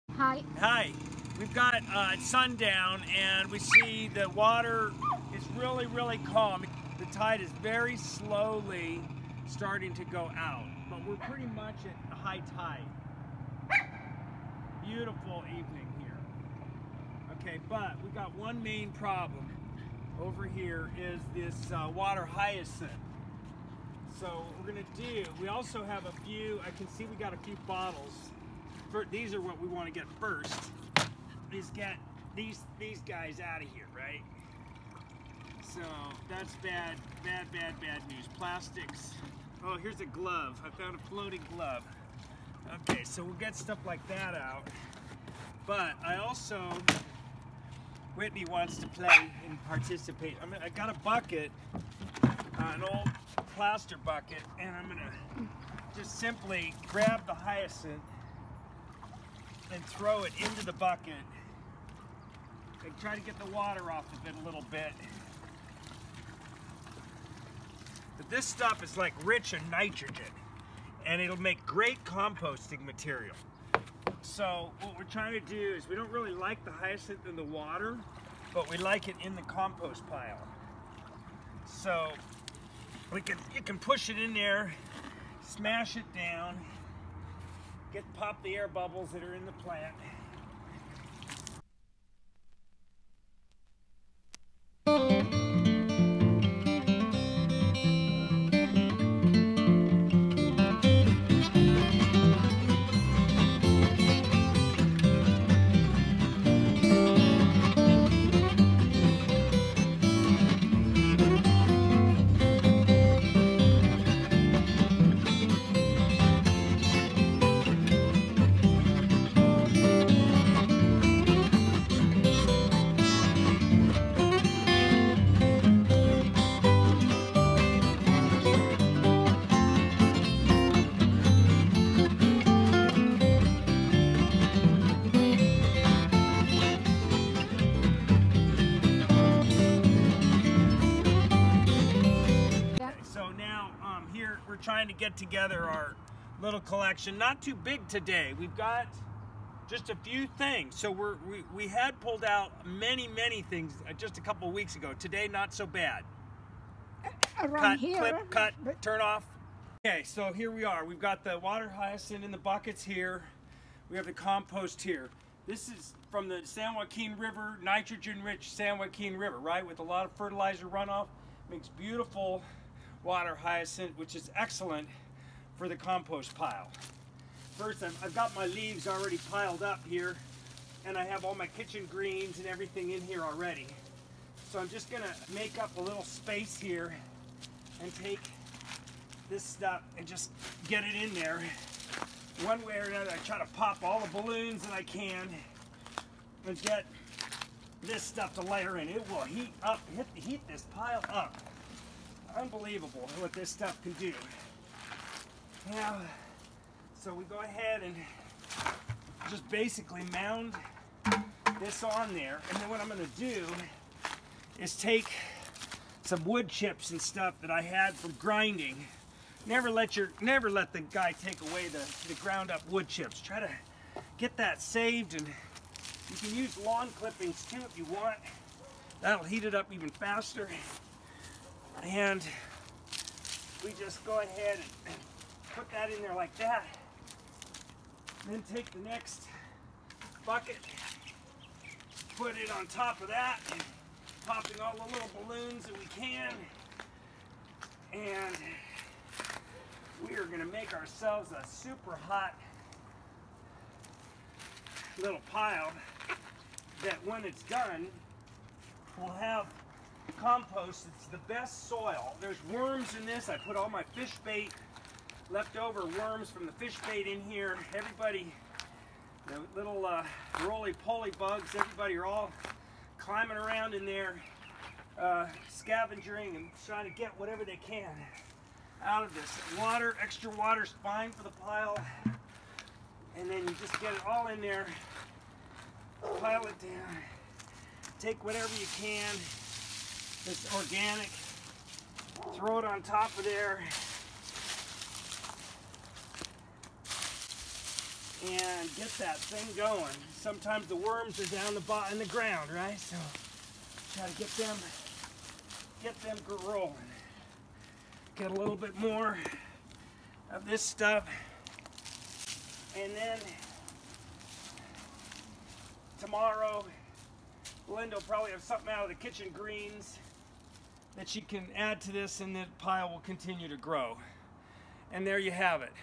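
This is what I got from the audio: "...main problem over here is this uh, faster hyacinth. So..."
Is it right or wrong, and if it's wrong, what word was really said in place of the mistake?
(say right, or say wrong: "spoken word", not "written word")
wrong: "water", not "faster".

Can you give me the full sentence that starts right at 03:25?
Now, so we go ahead and just basically mound this on there.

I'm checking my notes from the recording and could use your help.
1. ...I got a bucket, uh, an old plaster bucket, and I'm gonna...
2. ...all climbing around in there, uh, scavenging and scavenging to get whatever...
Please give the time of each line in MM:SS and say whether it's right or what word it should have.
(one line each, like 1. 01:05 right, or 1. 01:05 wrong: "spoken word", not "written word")
1. 00:50 right
2. 04:32 wrong: "trying", not "scavenging".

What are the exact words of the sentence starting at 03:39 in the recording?
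Never let your, never let the guy take away the, the ground up wood chips.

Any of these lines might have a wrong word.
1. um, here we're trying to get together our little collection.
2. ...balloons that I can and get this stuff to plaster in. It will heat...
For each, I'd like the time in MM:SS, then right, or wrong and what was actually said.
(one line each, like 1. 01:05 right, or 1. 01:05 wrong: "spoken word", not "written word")
1. 02:23 right
2. 03:14 wrong: "layer", not "plaster".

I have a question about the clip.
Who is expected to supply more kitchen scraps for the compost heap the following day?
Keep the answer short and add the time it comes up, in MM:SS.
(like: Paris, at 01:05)
Linda, at 05:17.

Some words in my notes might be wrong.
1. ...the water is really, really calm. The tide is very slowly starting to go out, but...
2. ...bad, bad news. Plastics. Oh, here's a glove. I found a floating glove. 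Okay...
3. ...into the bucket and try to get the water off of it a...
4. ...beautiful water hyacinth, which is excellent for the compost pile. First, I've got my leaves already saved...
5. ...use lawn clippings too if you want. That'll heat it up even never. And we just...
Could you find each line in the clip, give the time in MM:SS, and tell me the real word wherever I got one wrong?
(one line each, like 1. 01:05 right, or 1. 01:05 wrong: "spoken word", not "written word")
1. 00:04 right
2. 00:37 right
3. 01:00 right
4. 02:51 wrong: "piled", not "saved"
5. 03:46 wrong: "faster", not "never".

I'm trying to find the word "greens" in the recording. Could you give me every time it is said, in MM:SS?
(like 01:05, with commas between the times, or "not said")
03:01, 05:19.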